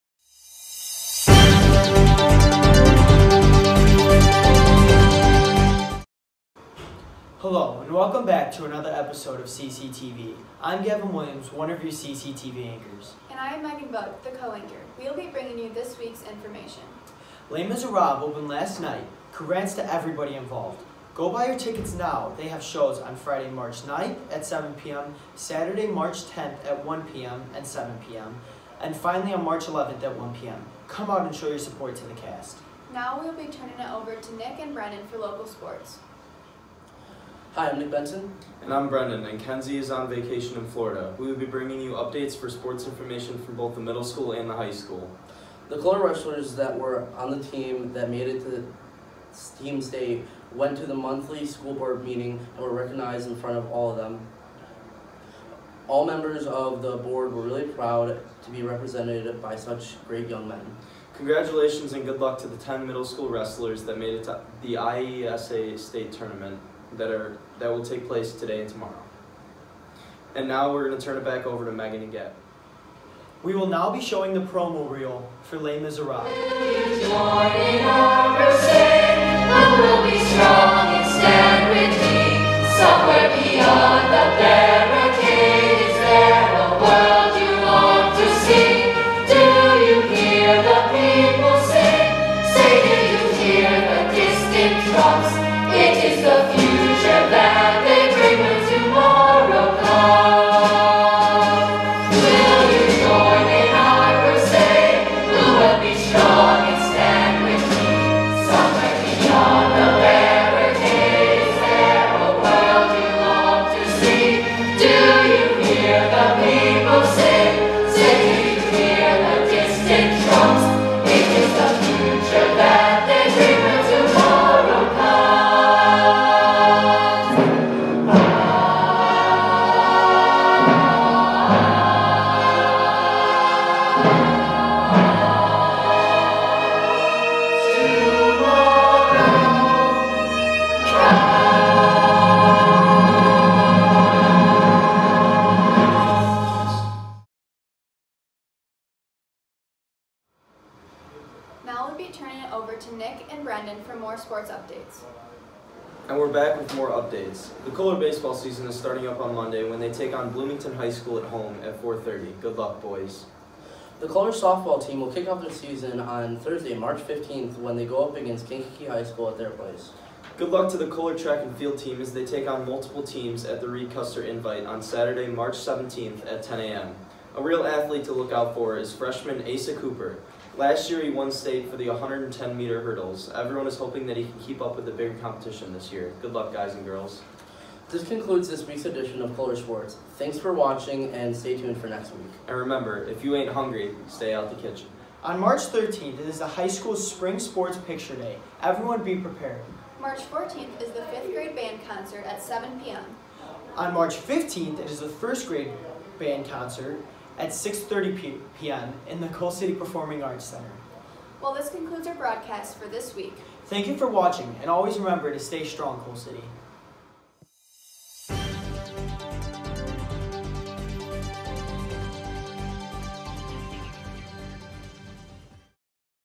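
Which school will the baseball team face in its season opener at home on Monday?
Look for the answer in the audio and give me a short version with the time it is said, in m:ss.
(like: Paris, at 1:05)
Bloomington High School, at 2:40.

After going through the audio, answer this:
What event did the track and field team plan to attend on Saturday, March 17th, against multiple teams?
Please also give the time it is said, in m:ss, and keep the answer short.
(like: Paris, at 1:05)
Reed Custer Invite, at 2:53.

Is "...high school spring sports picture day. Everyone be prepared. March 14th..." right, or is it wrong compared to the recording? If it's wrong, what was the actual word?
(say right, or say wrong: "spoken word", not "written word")
right.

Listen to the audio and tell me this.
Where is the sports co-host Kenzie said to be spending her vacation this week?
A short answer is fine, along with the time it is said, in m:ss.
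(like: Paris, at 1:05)
Florida, at 0:40.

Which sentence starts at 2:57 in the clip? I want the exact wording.
A real athlete to look out for is freshman Asa Cooper, Last year, he won state for the 110 meter hurdles.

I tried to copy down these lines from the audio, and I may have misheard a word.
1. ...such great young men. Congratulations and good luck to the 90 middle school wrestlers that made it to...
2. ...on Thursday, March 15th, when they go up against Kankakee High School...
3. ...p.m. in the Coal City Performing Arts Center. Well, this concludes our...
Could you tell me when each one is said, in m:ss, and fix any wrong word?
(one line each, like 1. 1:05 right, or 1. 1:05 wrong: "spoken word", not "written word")
1. 0:59 wrong: "10", not "90"
2. 2:46 right
3. 3:28 right.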